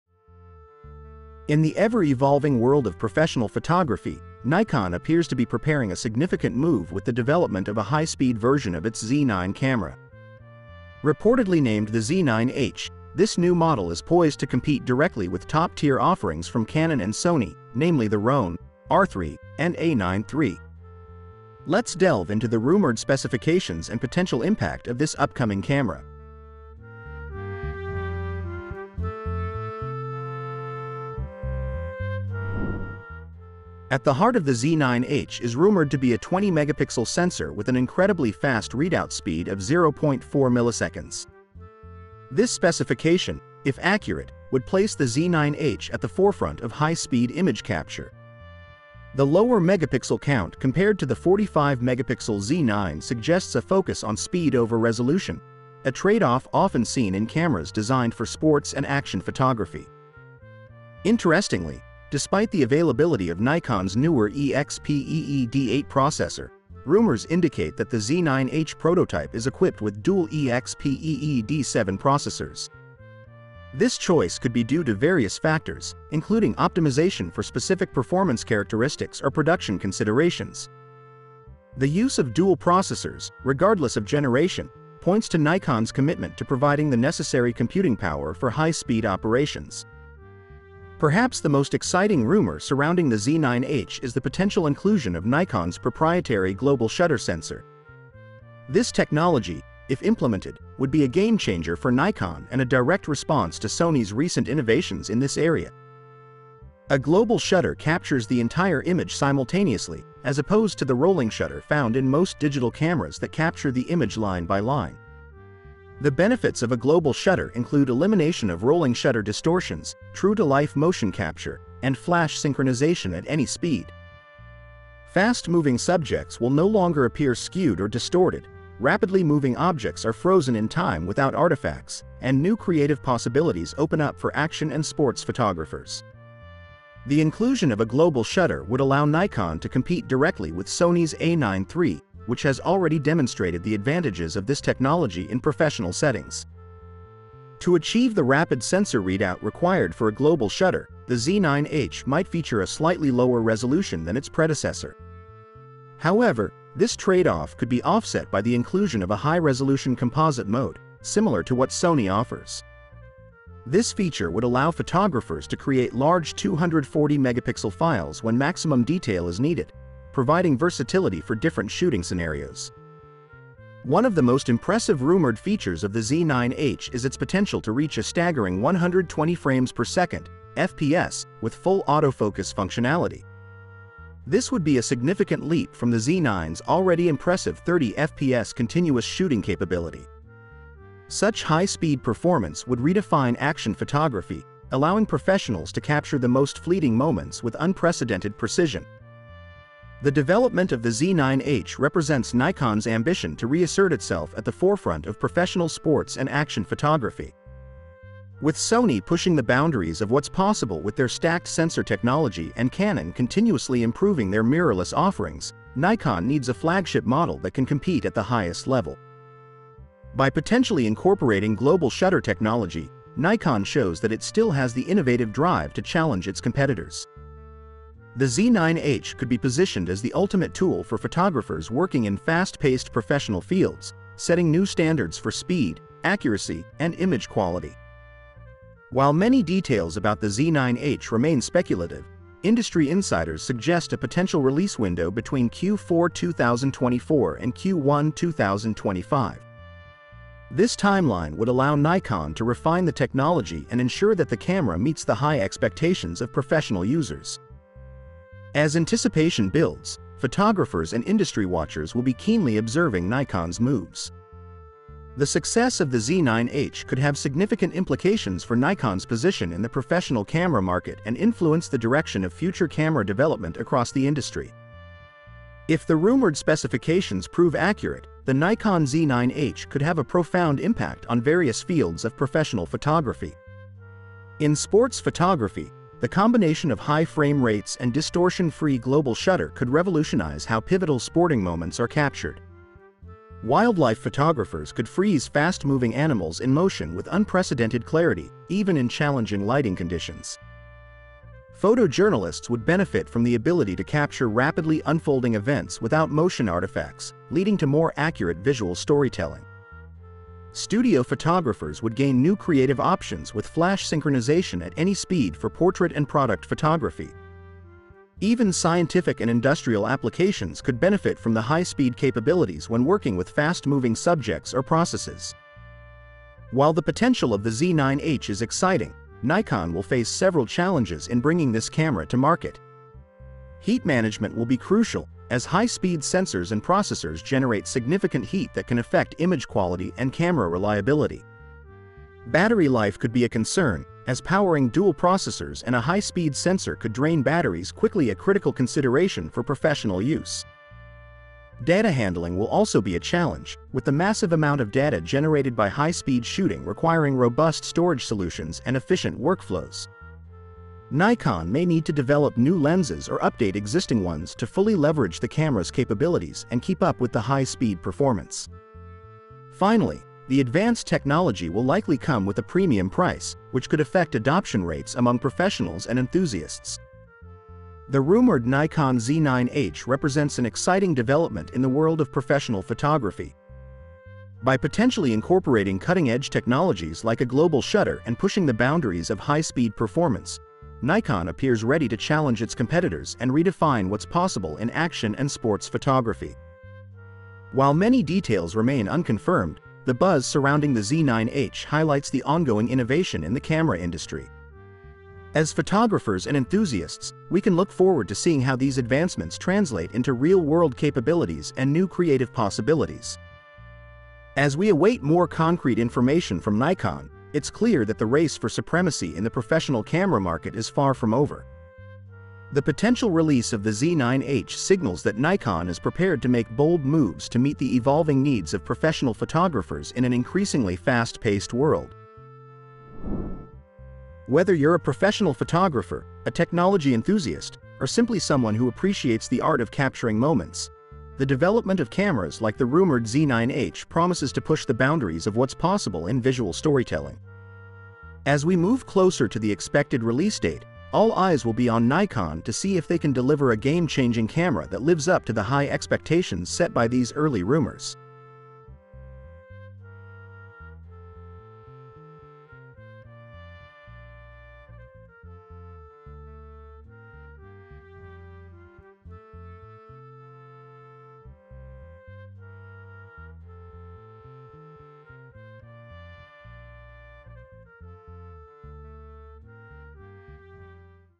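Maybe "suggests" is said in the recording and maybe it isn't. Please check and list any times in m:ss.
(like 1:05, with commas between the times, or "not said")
0:53, 4:03.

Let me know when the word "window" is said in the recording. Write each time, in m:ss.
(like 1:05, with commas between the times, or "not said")
4:04.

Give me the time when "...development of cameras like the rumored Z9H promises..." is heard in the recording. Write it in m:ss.
7:21.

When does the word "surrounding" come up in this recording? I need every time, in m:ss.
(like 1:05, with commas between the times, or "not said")
1:32, 6:40.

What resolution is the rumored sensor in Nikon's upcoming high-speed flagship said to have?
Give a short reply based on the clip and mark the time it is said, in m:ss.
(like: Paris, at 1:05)
20 megapixels, at 0:36.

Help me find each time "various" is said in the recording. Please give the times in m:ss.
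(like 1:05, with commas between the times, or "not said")
1:14, 4:41.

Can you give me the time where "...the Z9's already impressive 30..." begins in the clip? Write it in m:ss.
3:05.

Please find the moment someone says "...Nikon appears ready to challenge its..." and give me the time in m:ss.
6:30.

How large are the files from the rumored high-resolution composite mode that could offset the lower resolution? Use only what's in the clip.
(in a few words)
240 megapixels.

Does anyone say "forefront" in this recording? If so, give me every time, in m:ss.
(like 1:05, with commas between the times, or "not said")
0:46, 3:24.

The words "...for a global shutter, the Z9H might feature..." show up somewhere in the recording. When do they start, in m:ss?
2:29.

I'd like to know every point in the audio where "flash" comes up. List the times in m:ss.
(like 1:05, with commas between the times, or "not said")
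2:01, 5:13.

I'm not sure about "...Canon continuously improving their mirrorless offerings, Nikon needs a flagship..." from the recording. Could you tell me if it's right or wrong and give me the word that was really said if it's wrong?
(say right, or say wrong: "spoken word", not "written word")
right.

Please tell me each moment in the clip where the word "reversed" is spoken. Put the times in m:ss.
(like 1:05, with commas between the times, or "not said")
not said.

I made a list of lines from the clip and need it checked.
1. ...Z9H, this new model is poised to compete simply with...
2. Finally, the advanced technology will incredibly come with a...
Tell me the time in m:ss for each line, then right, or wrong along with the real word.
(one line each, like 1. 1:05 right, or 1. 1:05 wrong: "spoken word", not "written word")
1. 0:11 wrong: "directly", not "simply"
2. 6:09 wrong: "likely", not "incredibly".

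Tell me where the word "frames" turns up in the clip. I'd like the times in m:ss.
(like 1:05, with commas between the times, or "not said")
2:59, 4:47.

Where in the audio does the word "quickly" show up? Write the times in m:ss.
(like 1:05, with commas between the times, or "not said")
5:47.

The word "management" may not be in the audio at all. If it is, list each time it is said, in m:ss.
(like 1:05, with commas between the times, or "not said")
5:33.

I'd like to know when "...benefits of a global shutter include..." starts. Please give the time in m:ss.
1:56.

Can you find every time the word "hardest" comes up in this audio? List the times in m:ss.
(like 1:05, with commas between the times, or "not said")
not said.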